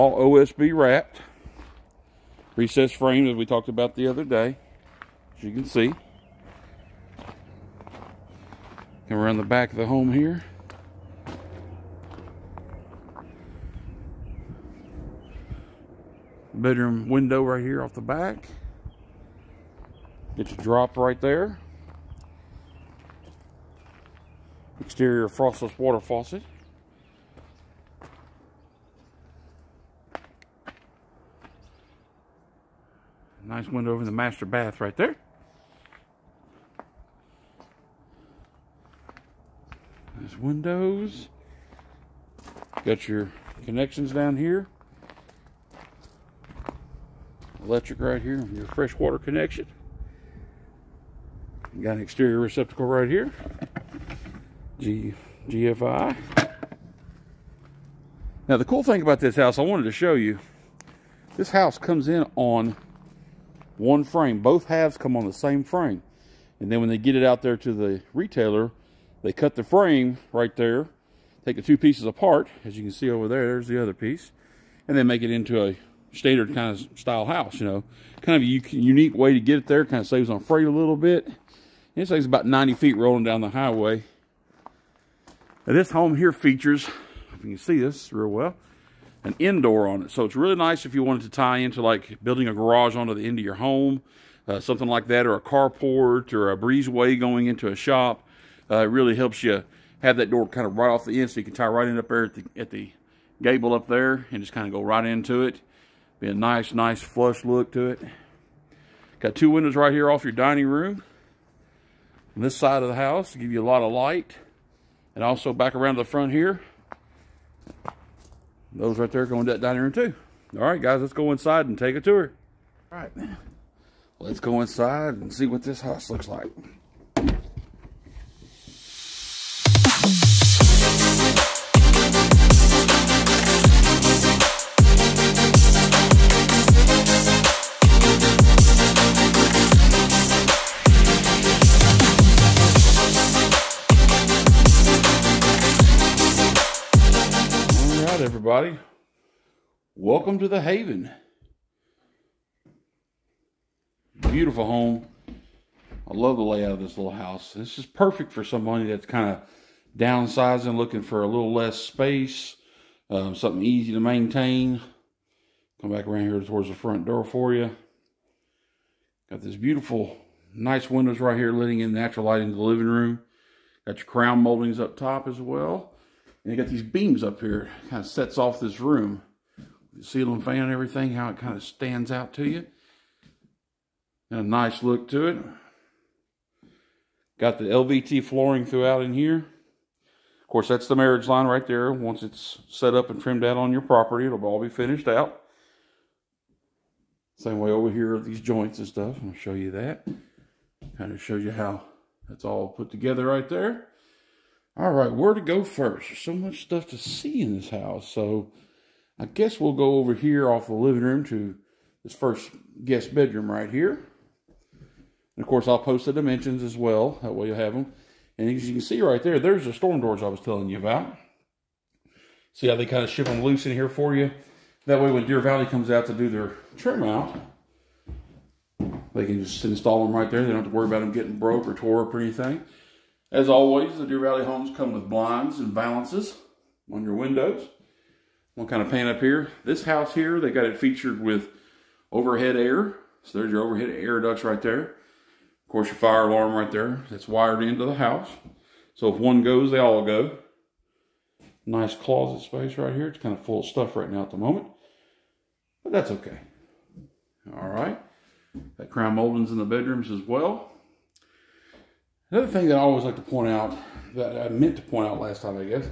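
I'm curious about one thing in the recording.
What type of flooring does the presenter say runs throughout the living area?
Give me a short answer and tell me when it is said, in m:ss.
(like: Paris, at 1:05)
LVT, at 3:07.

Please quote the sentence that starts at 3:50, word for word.
They don't have to worry about them getting broke or tore up or anything.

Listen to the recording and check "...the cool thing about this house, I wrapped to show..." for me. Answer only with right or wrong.
wrong.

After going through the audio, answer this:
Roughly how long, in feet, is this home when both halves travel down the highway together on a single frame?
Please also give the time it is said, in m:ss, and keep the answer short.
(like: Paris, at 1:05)
90 feet, at 1:22.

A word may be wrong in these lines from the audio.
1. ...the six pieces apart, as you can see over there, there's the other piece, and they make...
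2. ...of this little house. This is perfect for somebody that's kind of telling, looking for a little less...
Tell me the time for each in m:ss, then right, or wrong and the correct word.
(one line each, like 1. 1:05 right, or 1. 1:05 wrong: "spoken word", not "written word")
1. 1:11 wrong: "two", not "six"
2. 2:36 wrong: "downsizing", not "telling".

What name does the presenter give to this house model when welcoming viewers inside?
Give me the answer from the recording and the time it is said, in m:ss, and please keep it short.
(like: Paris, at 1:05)
The Haven, at 2:30.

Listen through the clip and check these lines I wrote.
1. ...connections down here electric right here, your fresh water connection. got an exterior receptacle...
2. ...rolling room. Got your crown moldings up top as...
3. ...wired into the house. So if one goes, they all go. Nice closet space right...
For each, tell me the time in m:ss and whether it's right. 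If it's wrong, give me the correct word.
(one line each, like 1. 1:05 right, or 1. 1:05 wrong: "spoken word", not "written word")
1. 0:43 right
2. 2:52 wrong: "living", not "rolling"
3. 4:07 right.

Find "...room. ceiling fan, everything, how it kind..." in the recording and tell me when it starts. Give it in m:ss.
2:58.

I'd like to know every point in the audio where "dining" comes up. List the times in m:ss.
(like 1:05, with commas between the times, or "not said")
1:50, 1:59.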